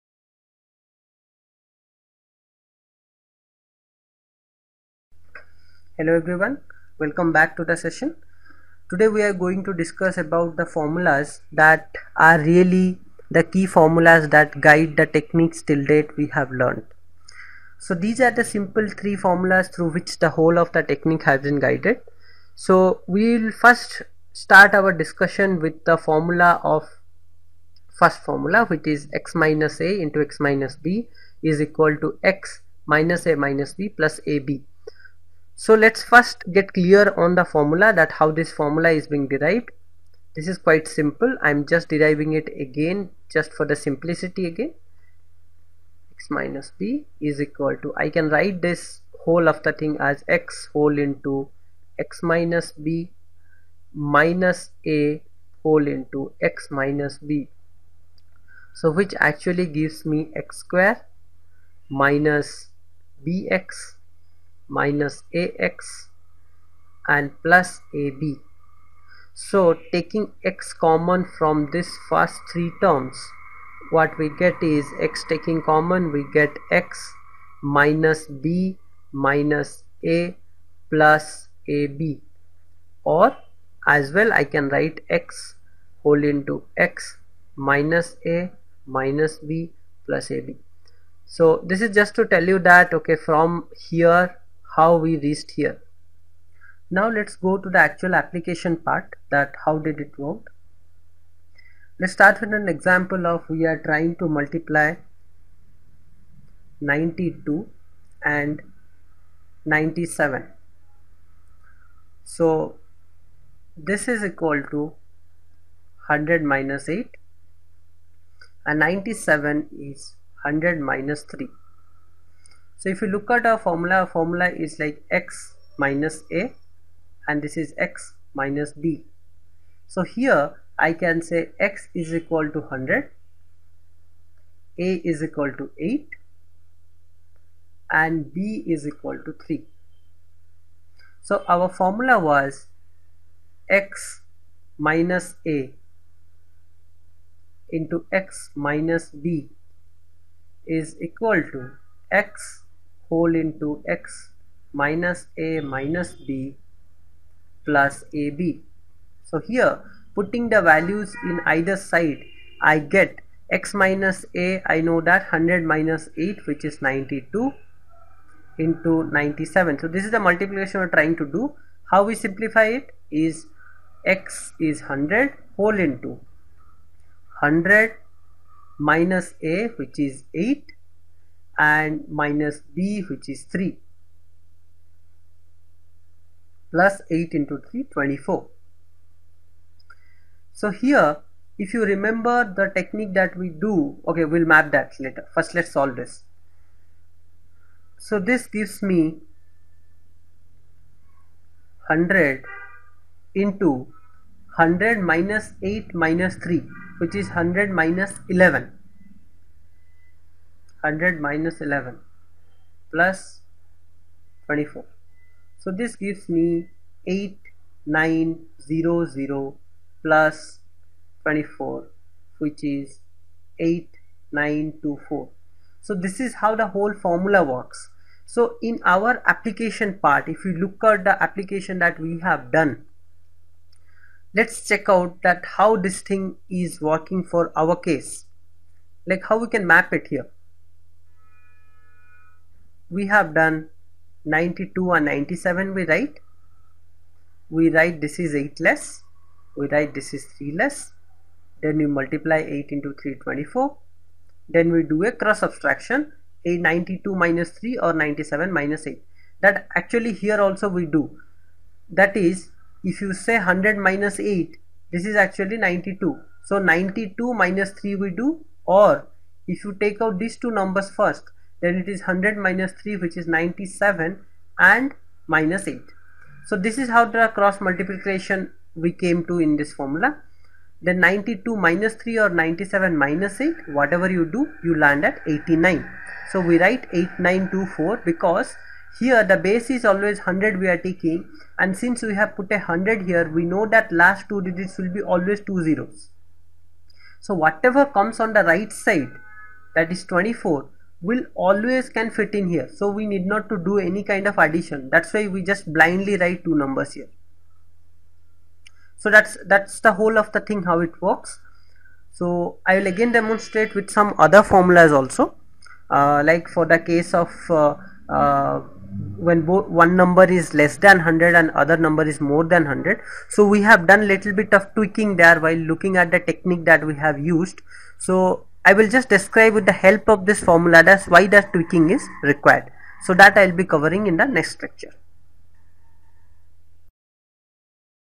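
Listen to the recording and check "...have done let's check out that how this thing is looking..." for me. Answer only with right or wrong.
wrong.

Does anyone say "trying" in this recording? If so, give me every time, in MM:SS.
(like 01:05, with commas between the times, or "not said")
01:43, 02:50.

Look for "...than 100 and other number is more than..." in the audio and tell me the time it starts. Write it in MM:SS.
05:20.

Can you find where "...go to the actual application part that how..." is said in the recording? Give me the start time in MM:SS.
01:37.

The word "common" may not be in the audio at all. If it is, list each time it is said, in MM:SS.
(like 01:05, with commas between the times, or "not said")
01:10, 01:15.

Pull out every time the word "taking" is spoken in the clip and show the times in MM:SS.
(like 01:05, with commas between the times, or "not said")
01:09, 01:15, 04:50.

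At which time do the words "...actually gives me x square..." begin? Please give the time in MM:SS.
00:59.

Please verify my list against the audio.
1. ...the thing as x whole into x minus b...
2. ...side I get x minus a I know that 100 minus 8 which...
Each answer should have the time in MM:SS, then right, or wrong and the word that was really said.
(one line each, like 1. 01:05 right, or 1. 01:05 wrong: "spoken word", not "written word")
1. 00:49 right
2. 02:41 right.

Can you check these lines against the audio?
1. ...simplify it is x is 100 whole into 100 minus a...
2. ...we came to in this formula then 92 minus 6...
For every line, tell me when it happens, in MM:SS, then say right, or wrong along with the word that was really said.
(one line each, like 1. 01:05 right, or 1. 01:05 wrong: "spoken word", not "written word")
1. 02:52 right
2. 04:38 wrong: "3", not "6".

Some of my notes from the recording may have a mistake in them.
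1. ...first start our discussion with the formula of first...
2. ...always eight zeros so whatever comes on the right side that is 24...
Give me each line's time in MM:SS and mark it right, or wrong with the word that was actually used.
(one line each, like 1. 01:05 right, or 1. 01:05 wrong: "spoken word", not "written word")
1. 00:23 right
2. 04:55 wrong: "two", not "eight".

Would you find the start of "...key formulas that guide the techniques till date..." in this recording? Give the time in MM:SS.
00:13.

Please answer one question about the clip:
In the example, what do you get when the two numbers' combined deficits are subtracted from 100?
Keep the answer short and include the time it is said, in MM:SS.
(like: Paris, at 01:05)
89, at 04:45.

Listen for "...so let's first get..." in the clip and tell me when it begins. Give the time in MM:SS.
00:35.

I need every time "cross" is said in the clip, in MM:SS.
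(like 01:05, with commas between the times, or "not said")
04:15, 04:37.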